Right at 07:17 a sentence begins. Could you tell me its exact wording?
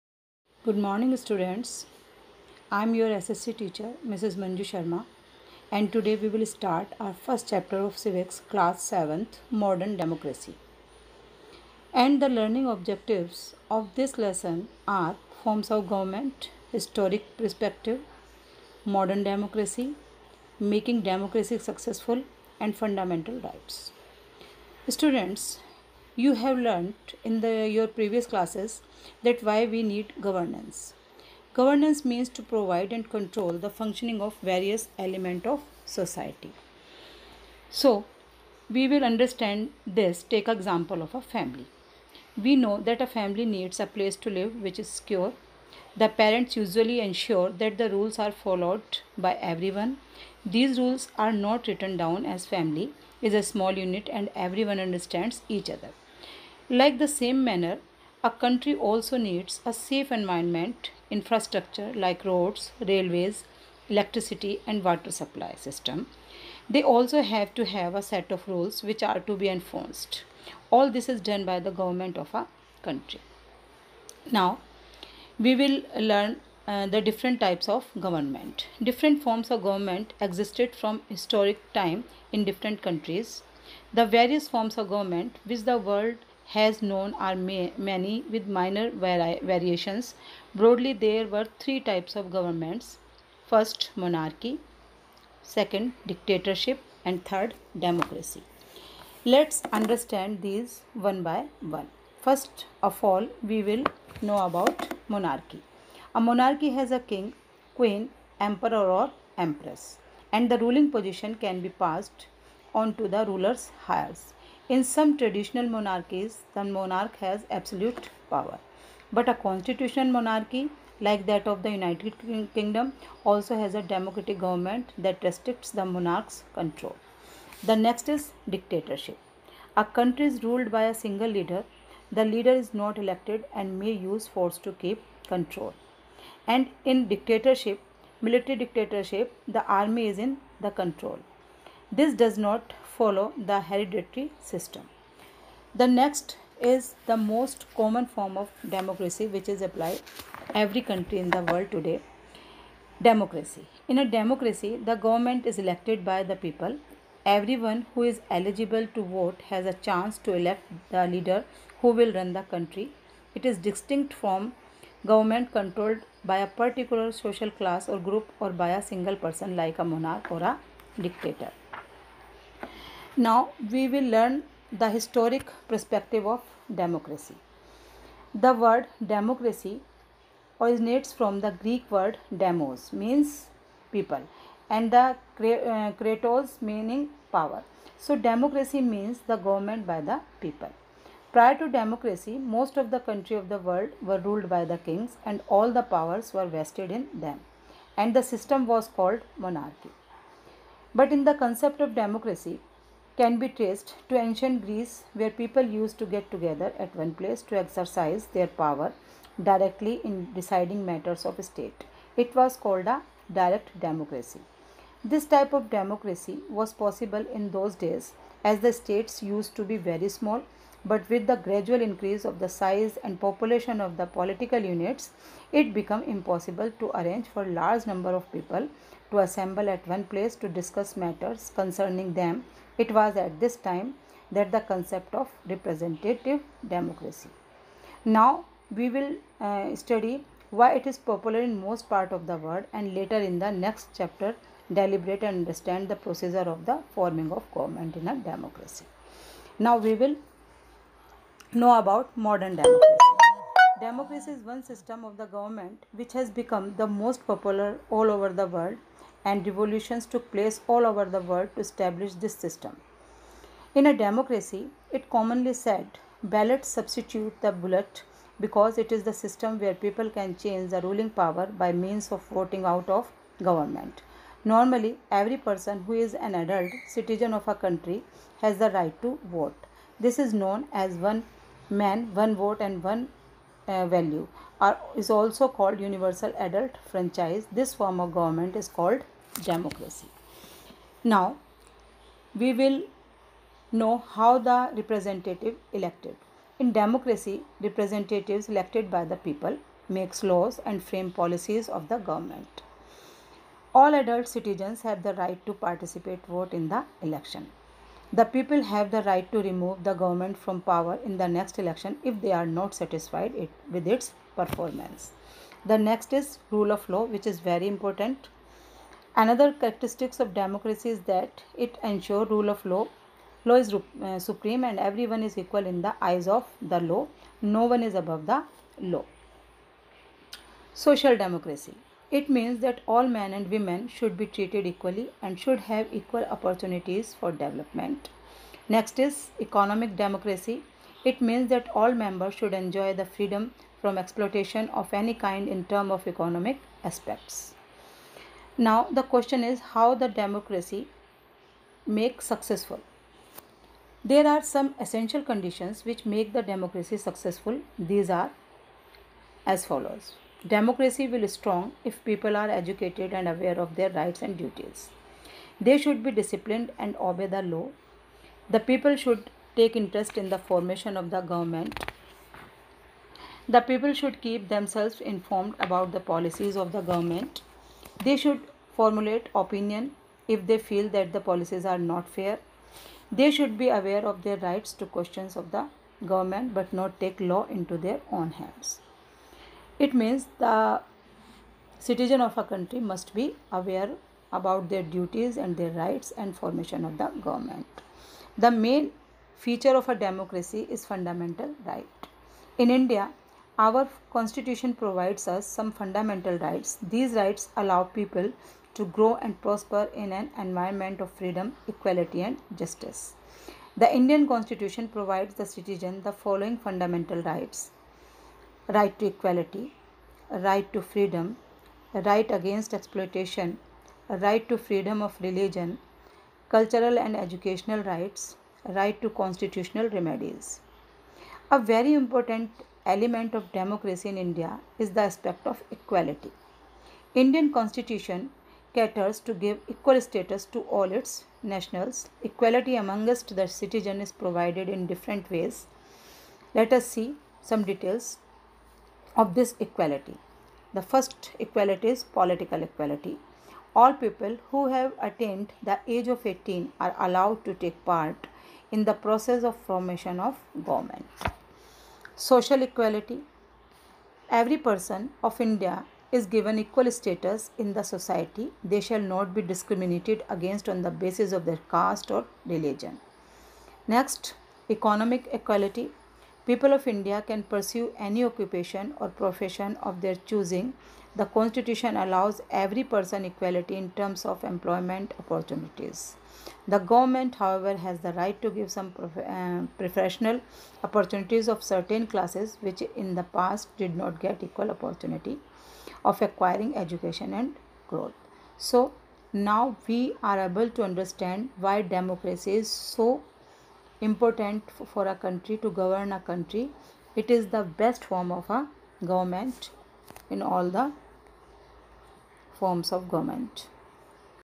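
Indian constitution caters to give equal status to all its nationals.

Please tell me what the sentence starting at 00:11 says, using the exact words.
And the learning objectives of this lesson are forms of government, historic perspective, modern democracy, making democracy successful, and fundamental rights.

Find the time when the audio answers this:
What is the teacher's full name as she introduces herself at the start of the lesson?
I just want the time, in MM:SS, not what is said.
00:04.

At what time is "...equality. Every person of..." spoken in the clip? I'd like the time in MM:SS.
07:42.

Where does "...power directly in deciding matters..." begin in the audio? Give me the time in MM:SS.
03:28.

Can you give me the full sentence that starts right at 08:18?
So, now we are able to understand why democracy is so important for a country to govern a country.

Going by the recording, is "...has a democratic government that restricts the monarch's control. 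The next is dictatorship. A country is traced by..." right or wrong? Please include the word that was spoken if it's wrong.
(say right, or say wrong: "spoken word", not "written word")
wrong: "ruled", not "traced".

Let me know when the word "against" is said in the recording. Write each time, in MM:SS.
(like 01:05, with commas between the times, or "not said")
07:02, 07:50.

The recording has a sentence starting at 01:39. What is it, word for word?
Let's understand these one by one.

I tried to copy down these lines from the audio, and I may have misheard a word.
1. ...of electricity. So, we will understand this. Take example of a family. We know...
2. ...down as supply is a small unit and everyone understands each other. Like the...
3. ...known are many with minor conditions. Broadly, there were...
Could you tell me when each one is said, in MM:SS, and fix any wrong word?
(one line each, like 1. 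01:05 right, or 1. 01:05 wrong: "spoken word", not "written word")
1. 00:35 wrong: "society", not "electricity"
2. 00:51 wrong: "family", not "supply"
3. 01:26 wrong: "variations", not "conditions".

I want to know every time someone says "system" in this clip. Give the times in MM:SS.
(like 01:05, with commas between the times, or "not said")
01:05, 02:24, 03:18, 04:14, 04:22, 04:29.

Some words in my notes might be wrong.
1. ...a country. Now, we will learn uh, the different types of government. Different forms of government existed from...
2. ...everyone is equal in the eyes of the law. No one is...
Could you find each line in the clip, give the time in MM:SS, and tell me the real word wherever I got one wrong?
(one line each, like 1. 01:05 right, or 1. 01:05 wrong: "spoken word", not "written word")
1. 01:12 right
2. 05:24 right.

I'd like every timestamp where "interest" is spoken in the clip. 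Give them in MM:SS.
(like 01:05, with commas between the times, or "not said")
06:09.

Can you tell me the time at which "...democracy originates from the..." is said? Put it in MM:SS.
02:59.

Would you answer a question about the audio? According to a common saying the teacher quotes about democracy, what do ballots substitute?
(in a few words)
The bullet.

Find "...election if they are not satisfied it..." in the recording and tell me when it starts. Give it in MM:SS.
05:11.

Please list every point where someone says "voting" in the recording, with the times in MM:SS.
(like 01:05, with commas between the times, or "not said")
04:32.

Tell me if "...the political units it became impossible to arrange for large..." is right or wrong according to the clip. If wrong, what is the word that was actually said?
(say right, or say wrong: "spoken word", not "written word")
right.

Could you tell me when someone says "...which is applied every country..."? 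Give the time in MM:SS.
02:29.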